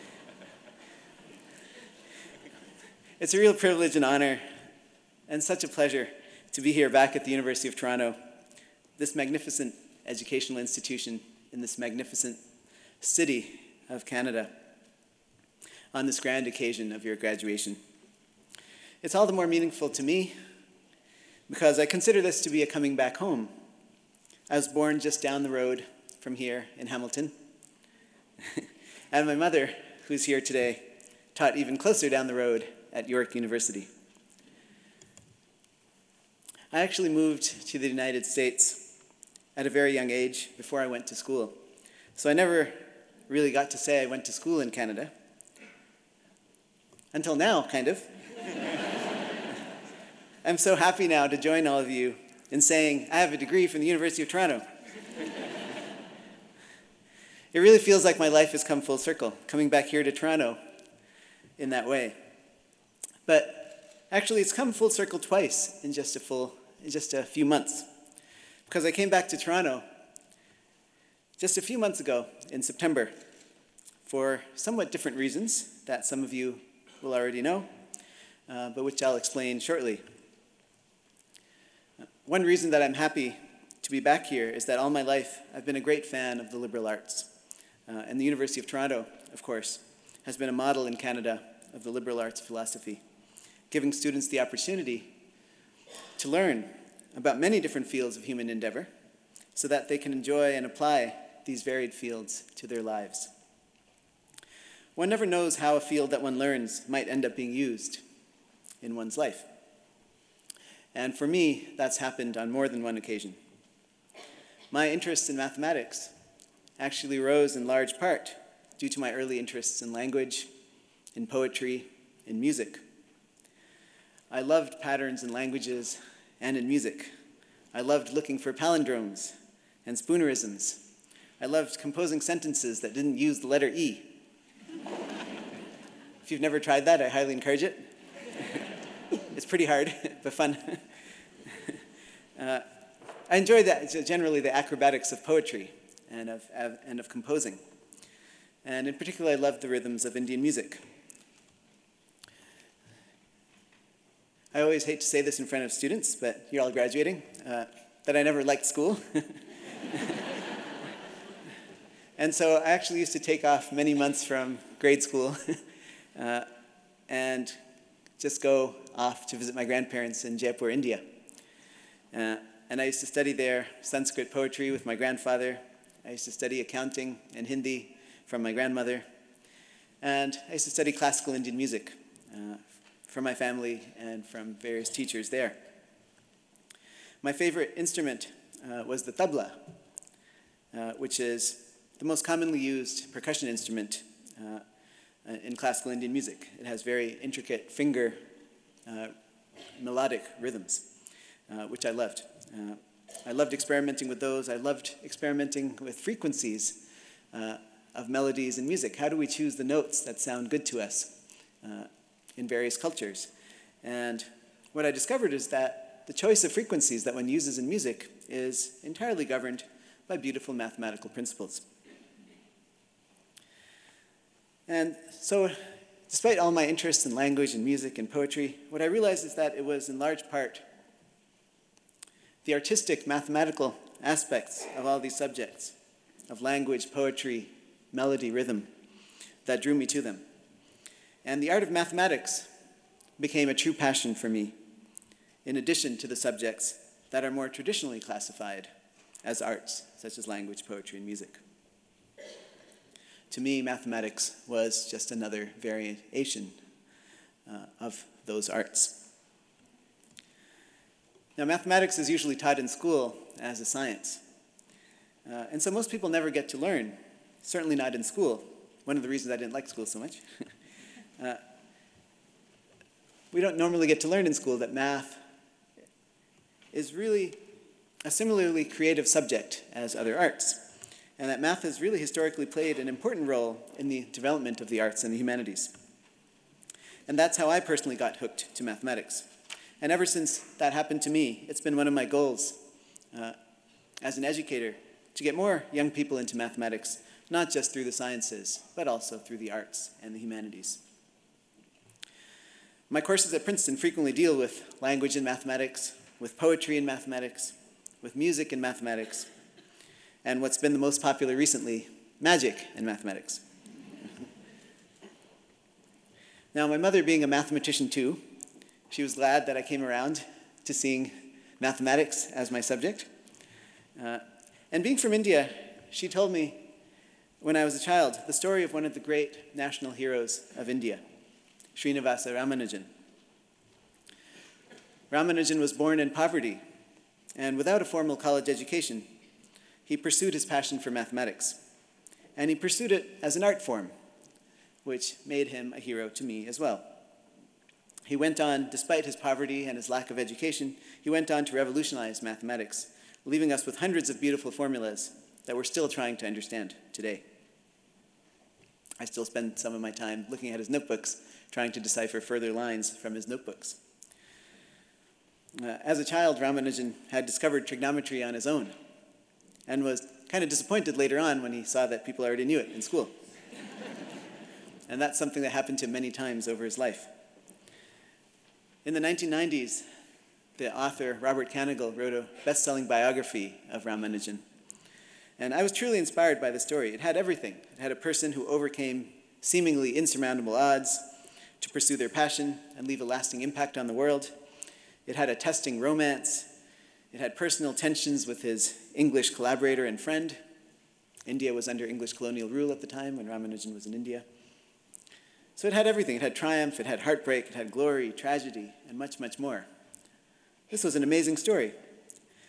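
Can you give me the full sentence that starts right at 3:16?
It has very intricate finger uh, melodic rhythms, uh, which I loved.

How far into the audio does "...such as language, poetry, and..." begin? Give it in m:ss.
4:09.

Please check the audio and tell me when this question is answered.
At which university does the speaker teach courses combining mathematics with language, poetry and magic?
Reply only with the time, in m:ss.
5:03.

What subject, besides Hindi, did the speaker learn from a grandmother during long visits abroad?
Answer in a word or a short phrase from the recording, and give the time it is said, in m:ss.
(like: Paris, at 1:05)
accounting, at 2:56.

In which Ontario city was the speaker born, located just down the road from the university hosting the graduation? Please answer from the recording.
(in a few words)
Hamilton.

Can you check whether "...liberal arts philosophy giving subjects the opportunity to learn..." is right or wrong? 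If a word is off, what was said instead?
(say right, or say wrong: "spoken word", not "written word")
wrong: "students", not "subjects".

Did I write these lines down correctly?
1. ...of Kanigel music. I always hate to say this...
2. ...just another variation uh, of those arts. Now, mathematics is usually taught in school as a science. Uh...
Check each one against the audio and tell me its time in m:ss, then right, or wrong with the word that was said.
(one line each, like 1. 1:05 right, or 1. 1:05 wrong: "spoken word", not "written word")
1. 2:30 wrong: "Indian", not "Kanigel"
2. 4:14 right.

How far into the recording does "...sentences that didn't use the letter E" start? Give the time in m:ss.
2:12.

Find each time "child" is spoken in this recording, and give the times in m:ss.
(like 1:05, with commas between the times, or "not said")
5:27, 6:06.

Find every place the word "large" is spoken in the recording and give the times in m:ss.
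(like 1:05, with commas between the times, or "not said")
1:57, 3:49.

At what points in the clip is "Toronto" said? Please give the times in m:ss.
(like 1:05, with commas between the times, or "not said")
0:07, 0:54, 1:00, 1:09, 1:28.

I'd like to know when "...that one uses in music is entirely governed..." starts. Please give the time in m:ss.
3:37.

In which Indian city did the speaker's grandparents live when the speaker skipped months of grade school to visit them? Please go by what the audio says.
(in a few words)
Jaipur.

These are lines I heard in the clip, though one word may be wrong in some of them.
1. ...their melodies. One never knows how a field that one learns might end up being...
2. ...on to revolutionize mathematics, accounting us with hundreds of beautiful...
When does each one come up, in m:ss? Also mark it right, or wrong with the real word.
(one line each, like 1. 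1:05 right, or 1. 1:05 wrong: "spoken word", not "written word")
1. 1:42 wrong: "lives", not "melodies"
2. 5:51 wrong: "leaving", not "accounting".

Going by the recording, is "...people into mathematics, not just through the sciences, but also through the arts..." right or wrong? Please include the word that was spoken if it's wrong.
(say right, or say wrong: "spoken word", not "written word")
right.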